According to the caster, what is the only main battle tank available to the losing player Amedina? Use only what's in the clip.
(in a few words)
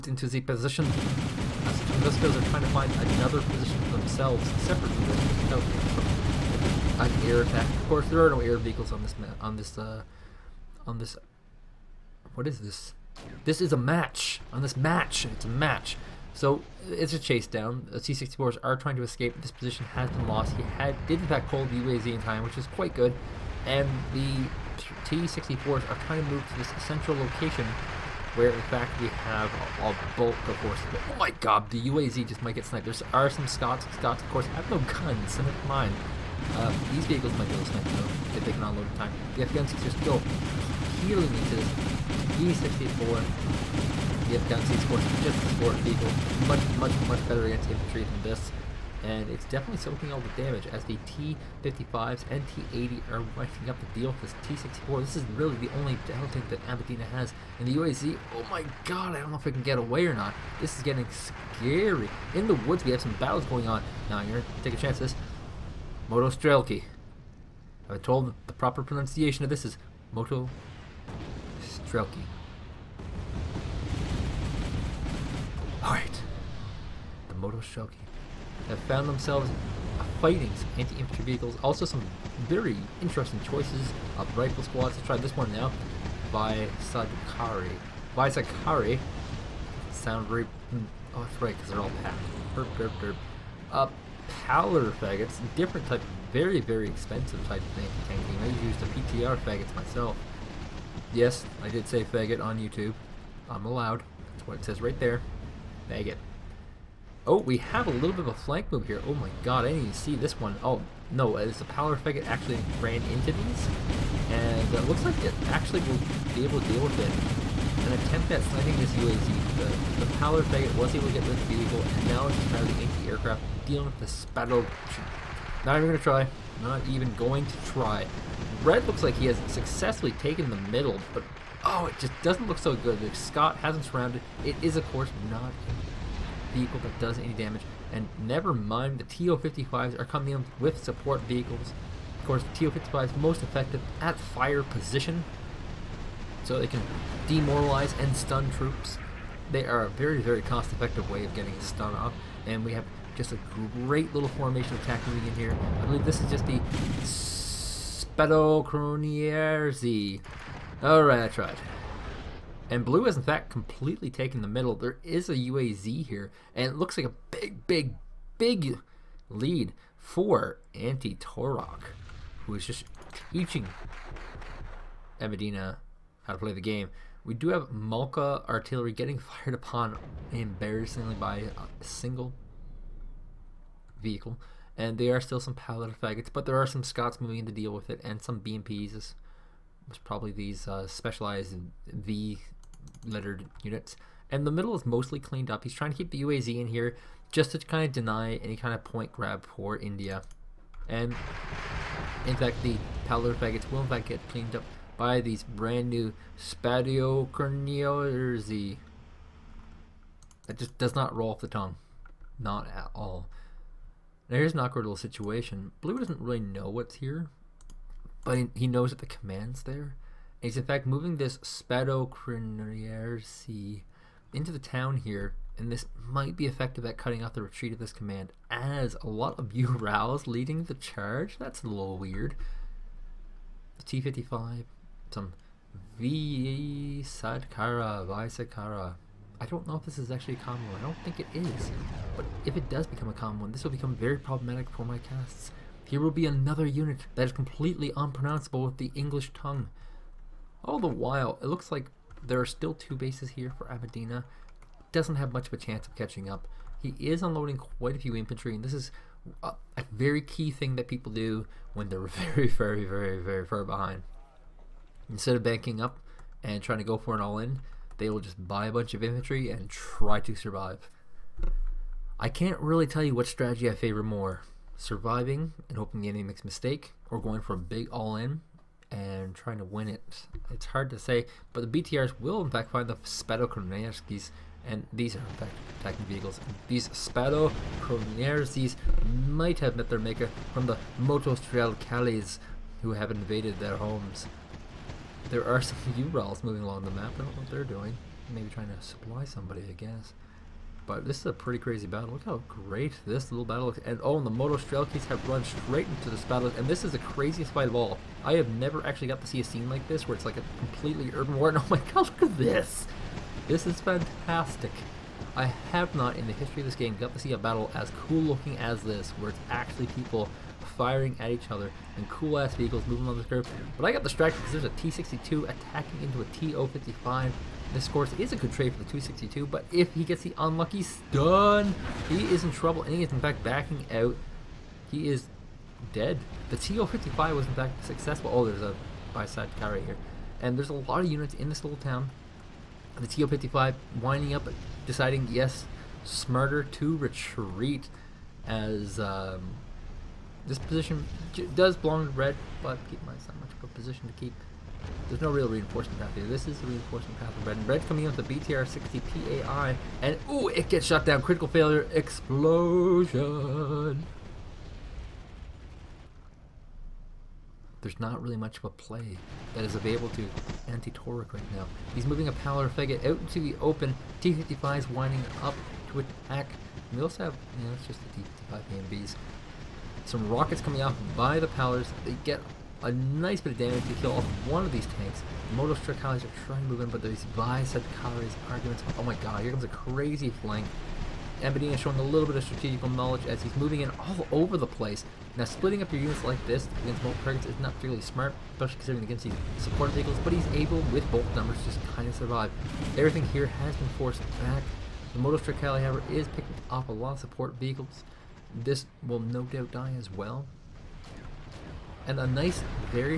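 T-64.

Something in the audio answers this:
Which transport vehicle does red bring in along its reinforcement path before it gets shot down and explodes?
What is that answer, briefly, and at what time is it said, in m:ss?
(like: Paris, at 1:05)
BTR 60 PAI, at 5:58.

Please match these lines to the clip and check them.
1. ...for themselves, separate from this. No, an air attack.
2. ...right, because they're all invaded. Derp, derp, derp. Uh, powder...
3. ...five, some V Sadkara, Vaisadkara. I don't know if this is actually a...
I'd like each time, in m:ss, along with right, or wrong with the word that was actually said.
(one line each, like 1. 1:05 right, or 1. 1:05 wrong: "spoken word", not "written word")
1. 0:03 right
2. 1:31 wrong: "packed", not "invaded"
3. 3:54 right.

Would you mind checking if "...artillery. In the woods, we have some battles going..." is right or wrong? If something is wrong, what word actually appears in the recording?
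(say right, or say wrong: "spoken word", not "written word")
wrong: "scary", not "artillery".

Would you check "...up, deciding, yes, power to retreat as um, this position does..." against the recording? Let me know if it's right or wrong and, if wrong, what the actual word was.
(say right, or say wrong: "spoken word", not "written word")
wrong: "smarter", not "power".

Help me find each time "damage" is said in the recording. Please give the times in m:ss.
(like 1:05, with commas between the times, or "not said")
0:50, 2:17, 6:23.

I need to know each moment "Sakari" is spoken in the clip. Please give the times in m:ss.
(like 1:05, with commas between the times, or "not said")
1:28.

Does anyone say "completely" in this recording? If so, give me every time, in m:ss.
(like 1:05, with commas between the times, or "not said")
2:43, 4:07, 5:10.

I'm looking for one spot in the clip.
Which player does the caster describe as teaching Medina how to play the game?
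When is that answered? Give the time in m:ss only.
2:50.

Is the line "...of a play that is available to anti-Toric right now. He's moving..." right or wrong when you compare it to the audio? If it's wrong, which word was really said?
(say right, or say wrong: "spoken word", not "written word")
right.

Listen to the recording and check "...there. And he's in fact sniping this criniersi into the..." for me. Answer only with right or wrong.
wrong.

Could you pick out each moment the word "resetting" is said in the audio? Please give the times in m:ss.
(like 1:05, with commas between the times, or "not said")
not said.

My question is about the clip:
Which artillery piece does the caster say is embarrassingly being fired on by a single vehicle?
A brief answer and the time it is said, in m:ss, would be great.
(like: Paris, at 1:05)
Malka, at 2:57.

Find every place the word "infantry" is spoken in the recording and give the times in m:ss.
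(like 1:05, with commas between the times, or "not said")
0:47, 1:20, 4:18, 4:29.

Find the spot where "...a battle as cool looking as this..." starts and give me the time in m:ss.
5:17.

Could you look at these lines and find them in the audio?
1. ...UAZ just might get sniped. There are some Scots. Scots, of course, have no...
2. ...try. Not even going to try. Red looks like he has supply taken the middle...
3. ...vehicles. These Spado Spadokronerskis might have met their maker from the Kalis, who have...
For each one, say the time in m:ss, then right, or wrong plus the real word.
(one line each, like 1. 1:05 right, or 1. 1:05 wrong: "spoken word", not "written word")
1. 0:31 right
2. 2:05 wrong: "successfully", not "supply"
3. 4:46 right.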